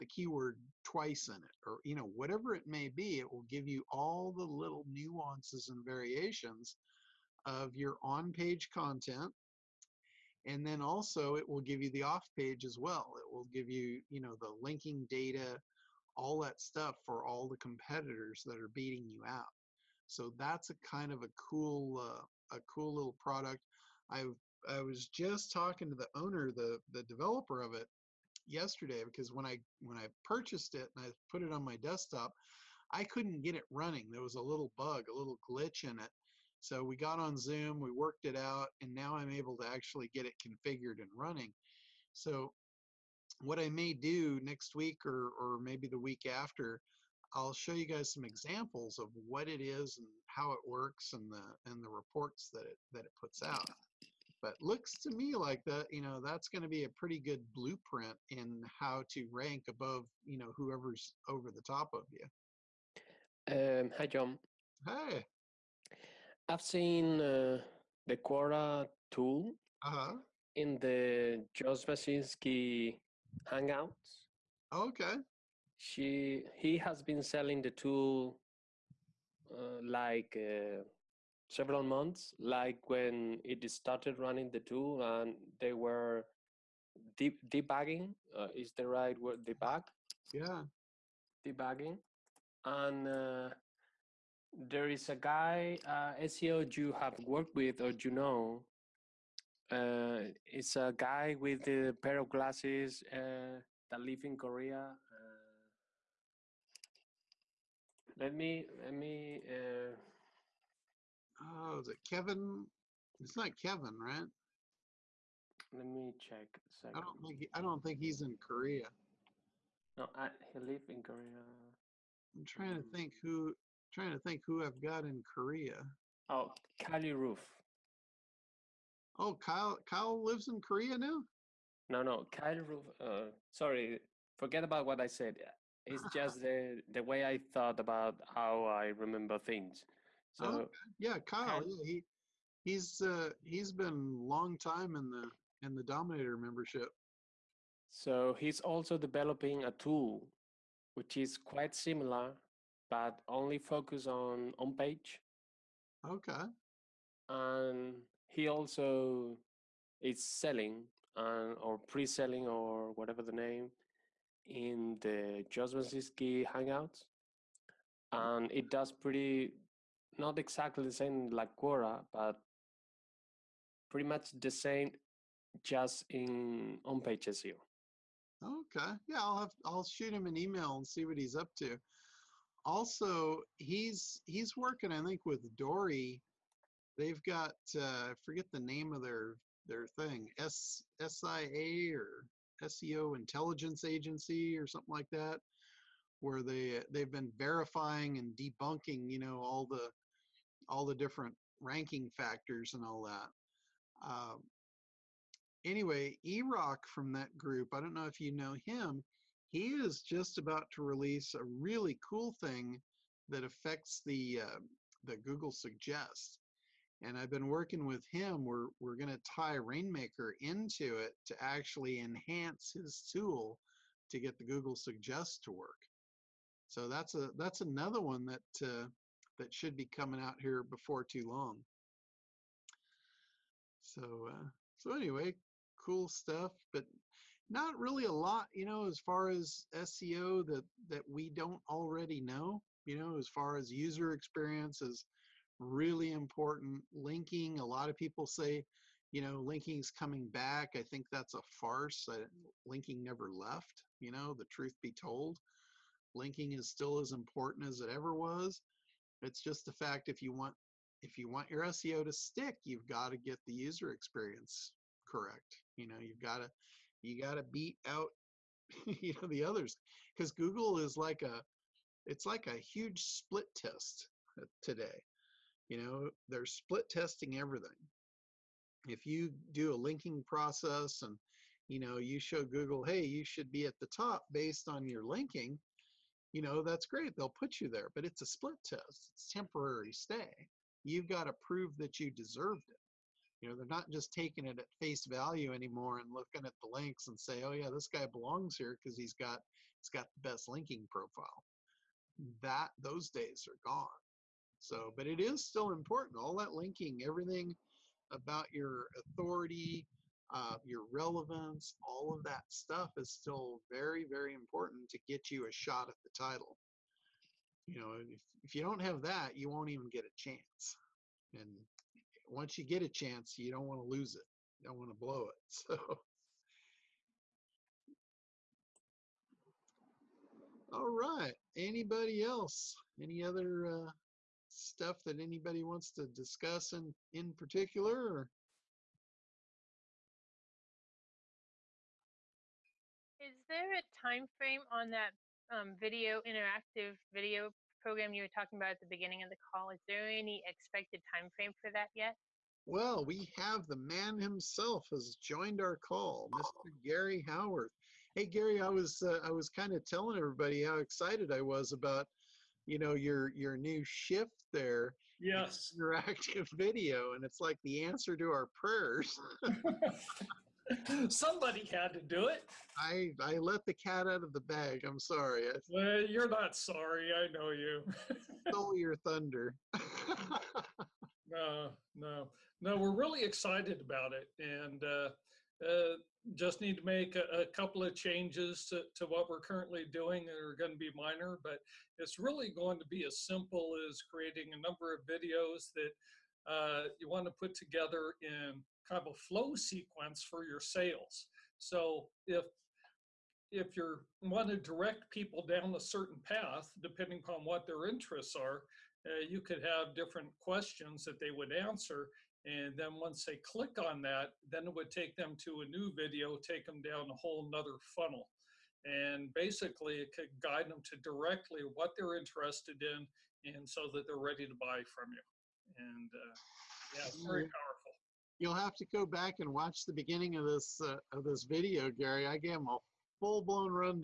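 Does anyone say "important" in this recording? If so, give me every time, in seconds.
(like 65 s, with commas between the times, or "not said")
246 s, 257 s, 305 s, 314 s.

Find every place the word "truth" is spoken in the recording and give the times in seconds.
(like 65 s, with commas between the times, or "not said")
254 s.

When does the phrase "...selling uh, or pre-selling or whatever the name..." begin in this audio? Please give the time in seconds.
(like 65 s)
160 s.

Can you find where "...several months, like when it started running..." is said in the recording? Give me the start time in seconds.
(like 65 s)
81 s.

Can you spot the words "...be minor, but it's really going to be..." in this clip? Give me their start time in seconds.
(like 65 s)
390 s.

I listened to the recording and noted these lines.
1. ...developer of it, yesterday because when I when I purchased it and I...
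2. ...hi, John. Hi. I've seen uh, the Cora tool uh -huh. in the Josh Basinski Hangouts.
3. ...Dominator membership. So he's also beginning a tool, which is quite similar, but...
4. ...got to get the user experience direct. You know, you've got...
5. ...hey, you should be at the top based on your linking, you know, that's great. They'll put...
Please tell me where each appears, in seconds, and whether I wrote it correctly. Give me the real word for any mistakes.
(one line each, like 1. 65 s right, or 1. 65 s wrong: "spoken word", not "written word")
1. 27 s right
2. 63 s right
3. 145 s wrong: "developing", not "beginning"
4. 262 s wrong: "correct", not "direct"
5. 282 s right.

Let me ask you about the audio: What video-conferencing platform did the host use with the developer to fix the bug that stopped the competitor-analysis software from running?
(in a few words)
Zoom.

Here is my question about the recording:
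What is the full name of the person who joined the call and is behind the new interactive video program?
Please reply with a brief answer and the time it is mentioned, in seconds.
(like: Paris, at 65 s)
Gary Howarth, at 356 s.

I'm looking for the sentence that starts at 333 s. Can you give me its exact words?
Any other uh, stuff that anybody wants to discuss in, in particular?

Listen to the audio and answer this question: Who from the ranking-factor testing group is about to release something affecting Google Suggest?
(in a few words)
Erock.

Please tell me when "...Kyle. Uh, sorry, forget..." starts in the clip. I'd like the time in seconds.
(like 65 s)
132 s.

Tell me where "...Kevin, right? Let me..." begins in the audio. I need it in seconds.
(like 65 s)
113 s.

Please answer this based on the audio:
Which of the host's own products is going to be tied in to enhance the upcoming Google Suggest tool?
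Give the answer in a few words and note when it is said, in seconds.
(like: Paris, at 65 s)
Rainmaker, at 219 s.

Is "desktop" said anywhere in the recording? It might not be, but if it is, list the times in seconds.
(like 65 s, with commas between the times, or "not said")
31 s.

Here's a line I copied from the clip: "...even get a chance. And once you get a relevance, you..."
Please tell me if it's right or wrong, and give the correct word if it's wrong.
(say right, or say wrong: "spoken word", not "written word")
wrong: "chance", not "relevance".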